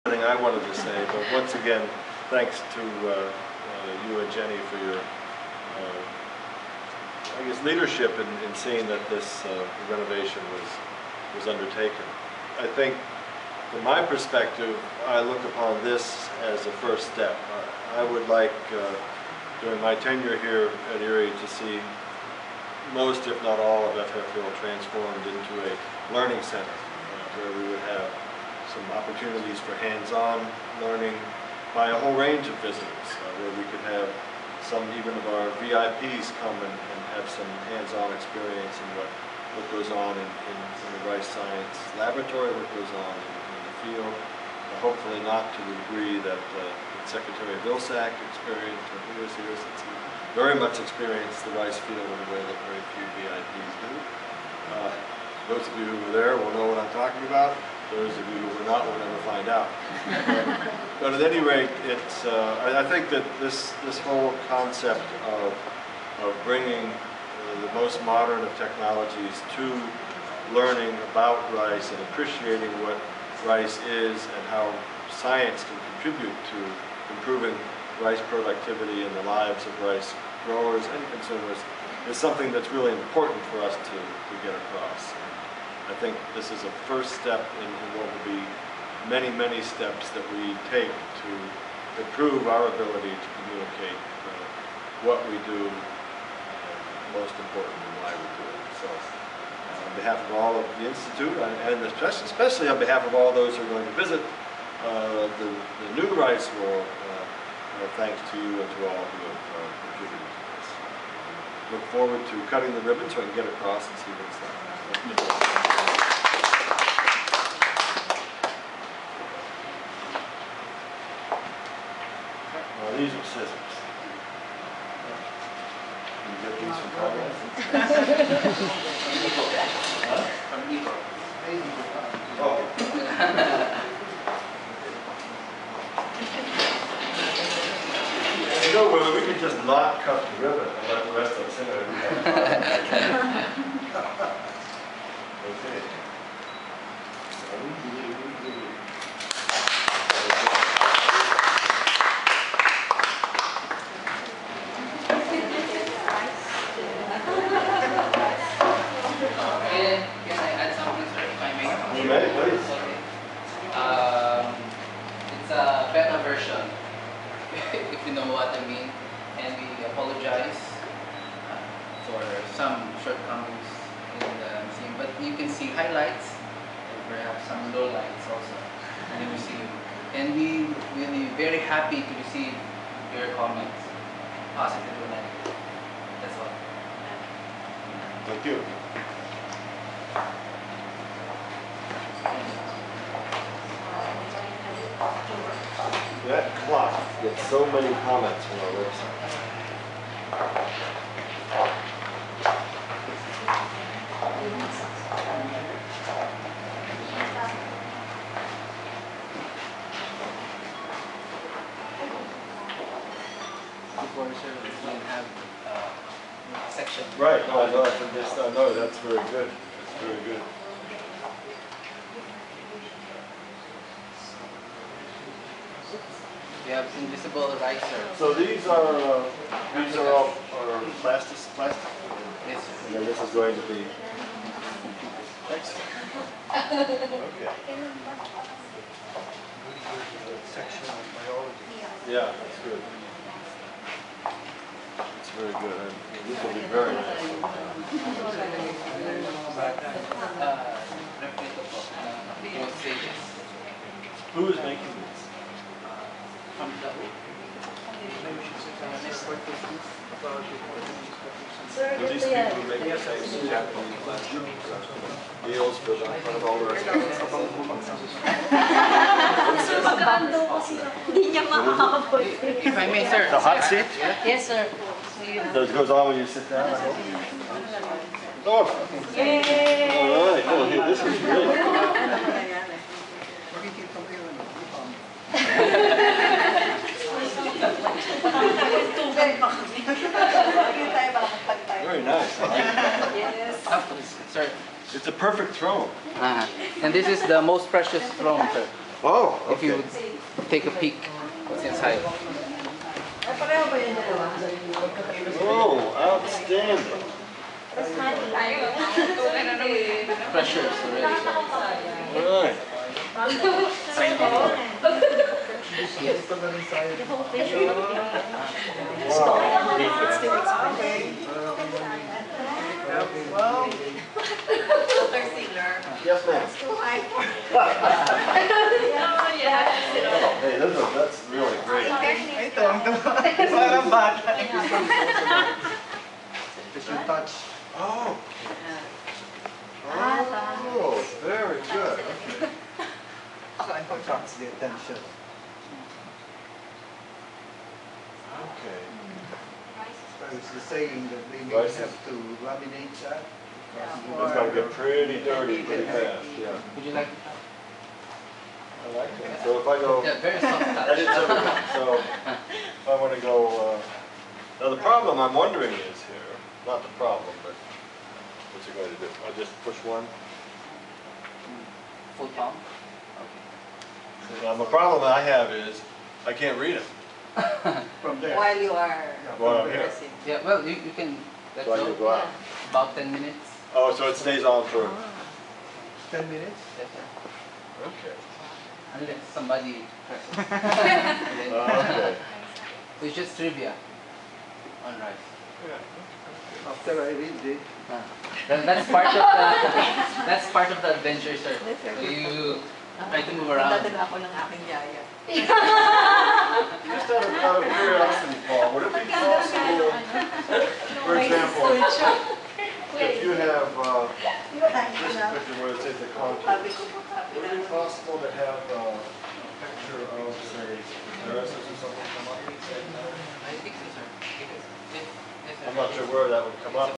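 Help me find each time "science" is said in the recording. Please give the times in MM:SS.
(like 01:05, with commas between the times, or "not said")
00:41, 01:15.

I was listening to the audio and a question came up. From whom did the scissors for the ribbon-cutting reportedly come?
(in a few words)
Evo.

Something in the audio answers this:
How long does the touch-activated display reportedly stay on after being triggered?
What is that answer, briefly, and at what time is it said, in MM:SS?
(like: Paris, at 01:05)
10 minutes, at 06:22.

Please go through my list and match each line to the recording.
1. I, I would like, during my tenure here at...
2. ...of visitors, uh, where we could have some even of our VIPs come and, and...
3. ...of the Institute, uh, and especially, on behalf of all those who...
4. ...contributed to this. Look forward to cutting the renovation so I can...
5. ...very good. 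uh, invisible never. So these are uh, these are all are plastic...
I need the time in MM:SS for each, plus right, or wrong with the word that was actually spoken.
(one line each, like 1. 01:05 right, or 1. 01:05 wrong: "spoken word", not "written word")
1. 00:17 right
2. 00:32 right
3. 01:40 right
4. 01:49 wrong: "ribbon", not "renovation"
5. 03:40 wrong: "riser", not "never".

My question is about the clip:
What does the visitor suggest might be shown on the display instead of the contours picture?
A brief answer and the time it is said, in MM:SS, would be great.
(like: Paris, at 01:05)
nurses, at 07:01.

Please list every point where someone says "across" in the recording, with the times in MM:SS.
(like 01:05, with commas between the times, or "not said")
01:24, 01:53.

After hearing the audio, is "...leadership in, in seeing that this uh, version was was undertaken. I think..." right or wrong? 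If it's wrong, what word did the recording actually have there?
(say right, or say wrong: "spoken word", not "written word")
wrong: "renovation", not "version".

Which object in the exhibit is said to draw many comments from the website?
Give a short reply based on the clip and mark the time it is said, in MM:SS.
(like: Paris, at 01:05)
that clock, at 03:16.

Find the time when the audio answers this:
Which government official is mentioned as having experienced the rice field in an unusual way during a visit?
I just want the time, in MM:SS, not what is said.
00:47.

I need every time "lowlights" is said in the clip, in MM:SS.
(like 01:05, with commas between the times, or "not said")
02:57.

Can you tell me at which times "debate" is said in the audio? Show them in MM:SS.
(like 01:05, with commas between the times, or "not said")
not said.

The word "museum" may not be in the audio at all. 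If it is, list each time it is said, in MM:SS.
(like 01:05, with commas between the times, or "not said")
02:54, 02:59.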